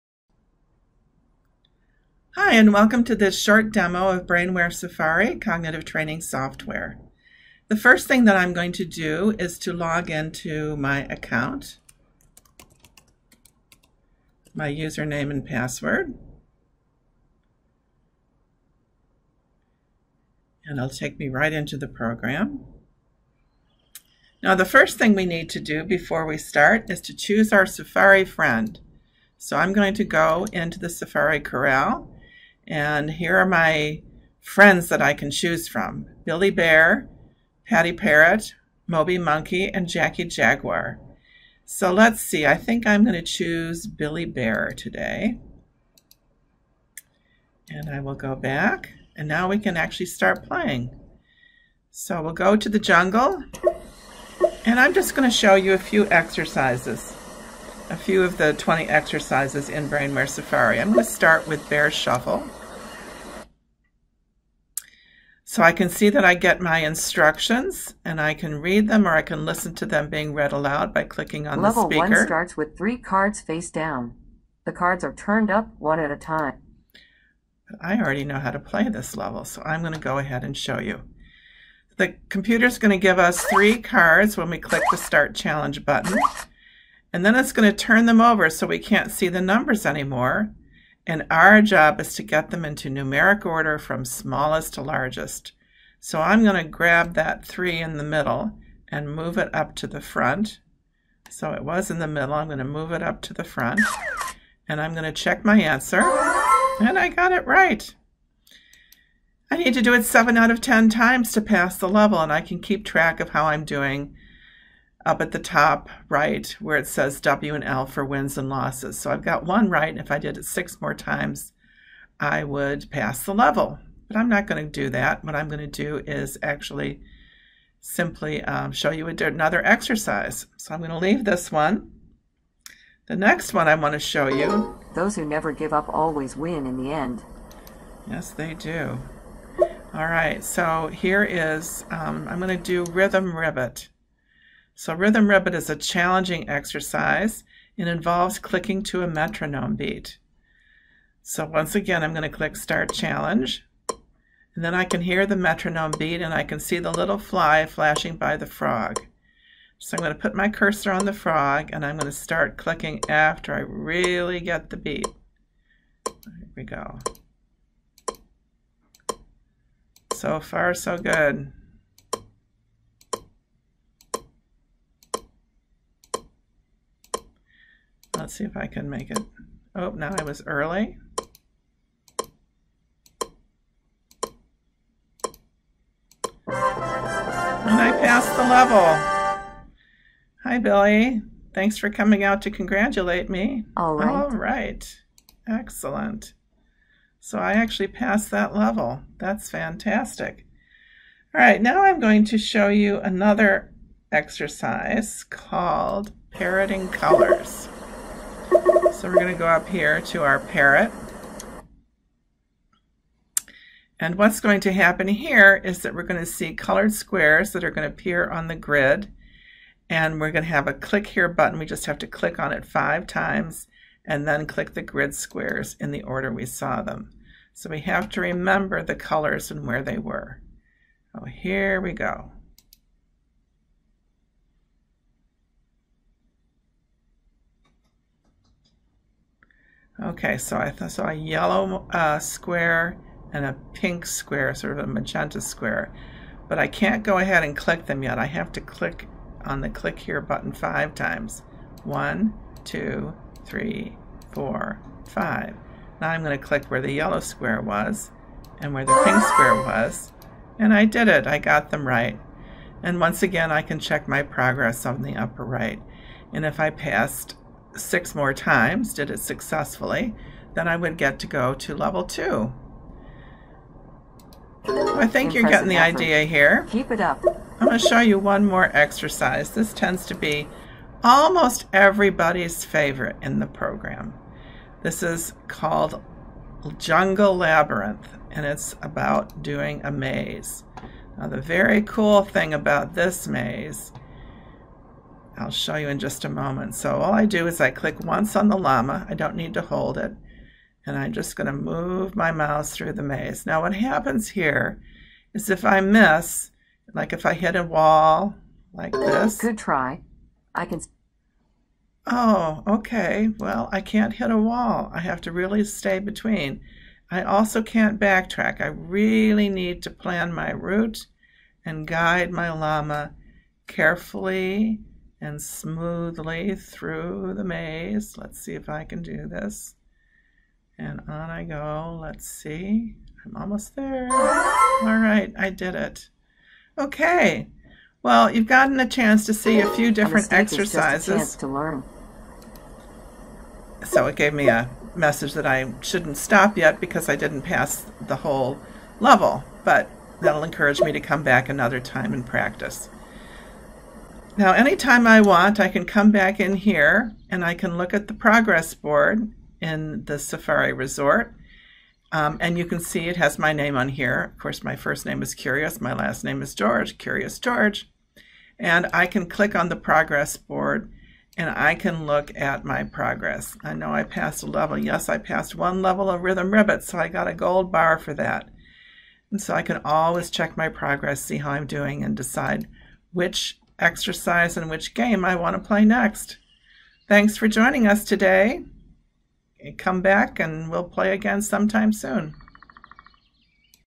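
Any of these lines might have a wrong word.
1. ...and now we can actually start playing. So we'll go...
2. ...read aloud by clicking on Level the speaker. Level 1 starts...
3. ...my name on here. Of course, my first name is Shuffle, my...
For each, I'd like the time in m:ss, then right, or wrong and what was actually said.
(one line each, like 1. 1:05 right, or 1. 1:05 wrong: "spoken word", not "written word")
1. 0:49 right
2. 1:10 right
3. 6:03 wrong: "Curious", not "Shuffle".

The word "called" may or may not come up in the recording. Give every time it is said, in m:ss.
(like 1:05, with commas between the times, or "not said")
3:25, 4:45.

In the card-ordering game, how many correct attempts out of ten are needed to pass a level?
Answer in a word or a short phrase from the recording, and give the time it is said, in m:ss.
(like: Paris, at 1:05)
7, at 1:50.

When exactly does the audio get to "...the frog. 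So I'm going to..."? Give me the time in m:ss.
2:38.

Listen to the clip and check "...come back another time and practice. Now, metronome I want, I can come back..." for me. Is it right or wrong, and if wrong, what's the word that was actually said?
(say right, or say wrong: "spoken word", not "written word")
wrong: "anytime", not "metronome".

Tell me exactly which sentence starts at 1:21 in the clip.
The computer is going to give us three cards when we click the Start Challenge button.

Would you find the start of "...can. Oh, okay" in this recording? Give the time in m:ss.
5:10.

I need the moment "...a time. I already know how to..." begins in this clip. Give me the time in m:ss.
1:16.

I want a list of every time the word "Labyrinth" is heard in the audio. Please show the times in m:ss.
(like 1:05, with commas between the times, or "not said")
4:47.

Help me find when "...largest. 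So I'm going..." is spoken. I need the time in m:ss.
1:34.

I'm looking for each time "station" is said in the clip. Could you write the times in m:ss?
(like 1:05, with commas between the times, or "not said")
not said.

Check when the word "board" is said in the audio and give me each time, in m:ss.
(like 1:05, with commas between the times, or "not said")
5:58, 6:10.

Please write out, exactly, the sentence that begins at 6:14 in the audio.
Yes, I passed one level of Rhythm Ribbit, so I got a gold bar for that.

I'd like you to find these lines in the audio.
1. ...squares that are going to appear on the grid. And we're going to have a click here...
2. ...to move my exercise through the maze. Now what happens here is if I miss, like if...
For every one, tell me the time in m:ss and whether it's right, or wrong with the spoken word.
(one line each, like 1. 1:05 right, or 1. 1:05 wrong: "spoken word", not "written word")
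1. 3:36 right
2. 5:01 wrong: "mouse", not "exercise".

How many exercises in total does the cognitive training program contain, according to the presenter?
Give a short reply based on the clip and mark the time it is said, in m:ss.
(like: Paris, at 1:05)
20, at 0:58.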